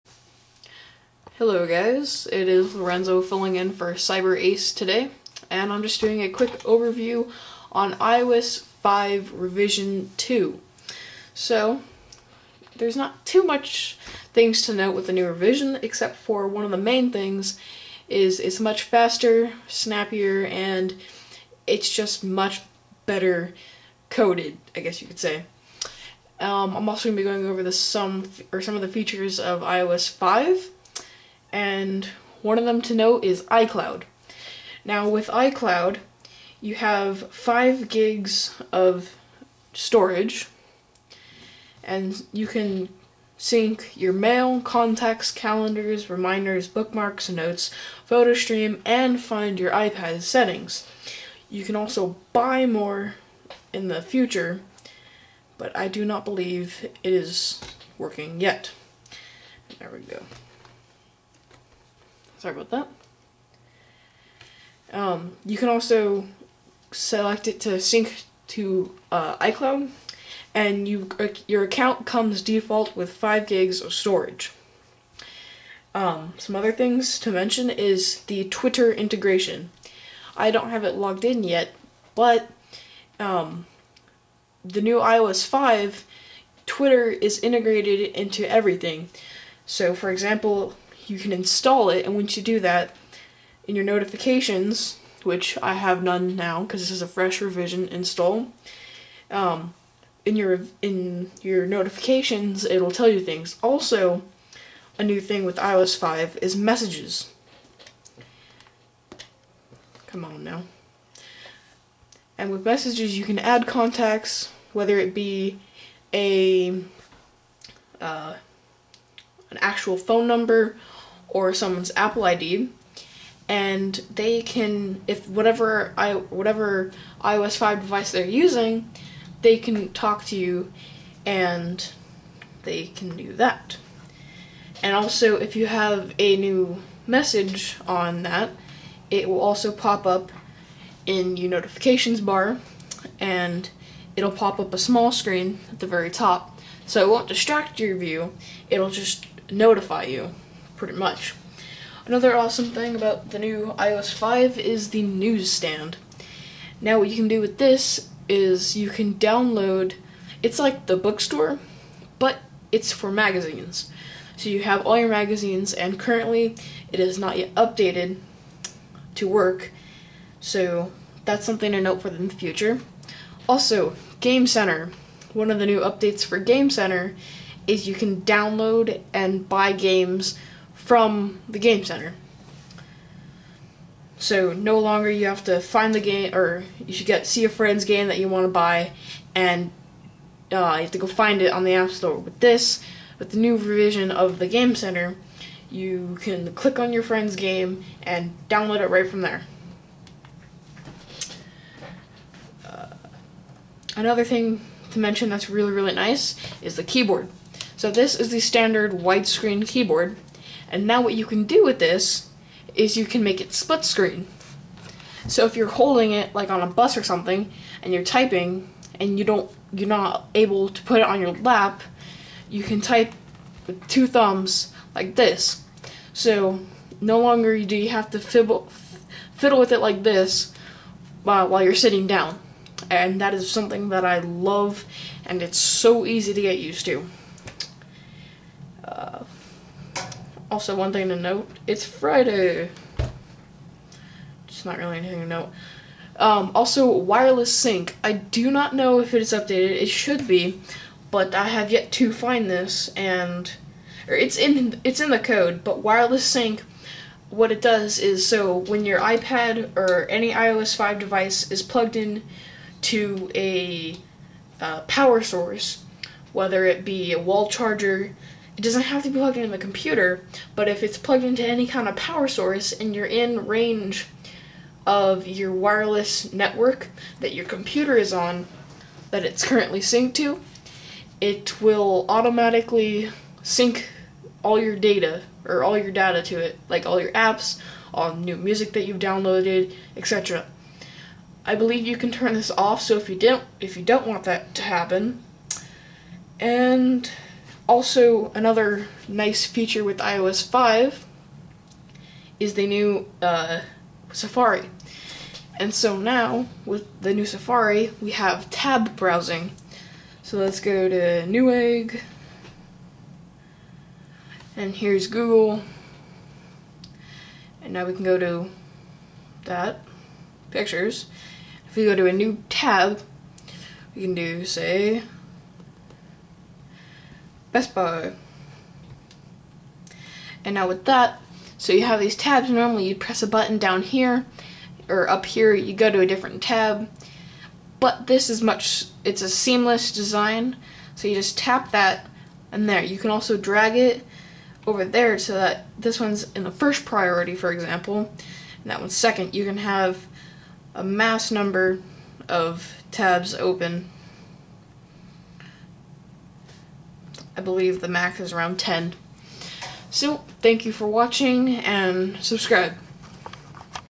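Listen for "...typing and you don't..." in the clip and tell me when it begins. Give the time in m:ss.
3:38.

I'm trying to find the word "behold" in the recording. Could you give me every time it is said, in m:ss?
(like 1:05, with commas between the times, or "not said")
not said.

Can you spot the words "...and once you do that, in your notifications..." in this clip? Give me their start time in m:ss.
1:32.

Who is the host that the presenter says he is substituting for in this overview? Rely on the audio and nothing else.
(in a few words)
Cyber Ace.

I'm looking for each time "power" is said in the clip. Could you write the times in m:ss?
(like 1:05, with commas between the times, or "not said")
4:24, 4:31.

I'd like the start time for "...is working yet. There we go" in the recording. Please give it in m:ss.
0:57.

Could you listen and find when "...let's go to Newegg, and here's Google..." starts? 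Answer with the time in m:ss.
5:10.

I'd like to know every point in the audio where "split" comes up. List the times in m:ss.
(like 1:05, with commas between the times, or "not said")
3:33.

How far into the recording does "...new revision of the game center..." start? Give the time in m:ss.
3:13.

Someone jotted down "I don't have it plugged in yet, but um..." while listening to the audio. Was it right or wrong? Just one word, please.
wrong.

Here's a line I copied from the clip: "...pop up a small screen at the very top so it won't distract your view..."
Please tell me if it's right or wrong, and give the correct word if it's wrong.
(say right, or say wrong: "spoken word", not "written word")
right.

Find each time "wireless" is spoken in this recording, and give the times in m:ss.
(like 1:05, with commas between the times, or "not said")
4:06, 4:15, 4:35.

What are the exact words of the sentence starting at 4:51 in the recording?
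I believe you can turn this off so if you don't if you don't want that to happen.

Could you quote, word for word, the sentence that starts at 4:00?
Also, one thing to note, it's Friday.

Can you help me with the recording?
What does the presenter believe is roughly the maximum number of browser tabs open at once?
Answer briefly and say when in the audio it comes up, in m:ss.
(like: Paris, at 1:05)
10, at 5:58.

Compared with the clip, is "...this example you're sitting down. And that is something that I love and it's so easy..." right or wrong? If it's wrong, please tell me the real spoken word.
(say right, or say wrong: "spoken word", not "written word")
wrong: "while", not "example".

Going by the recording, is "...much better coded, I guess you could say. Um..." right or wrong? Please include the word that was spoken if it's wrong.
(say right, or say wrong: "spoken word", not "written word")
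right.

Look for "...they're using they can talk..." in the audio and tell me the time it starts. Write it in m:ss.
2:08.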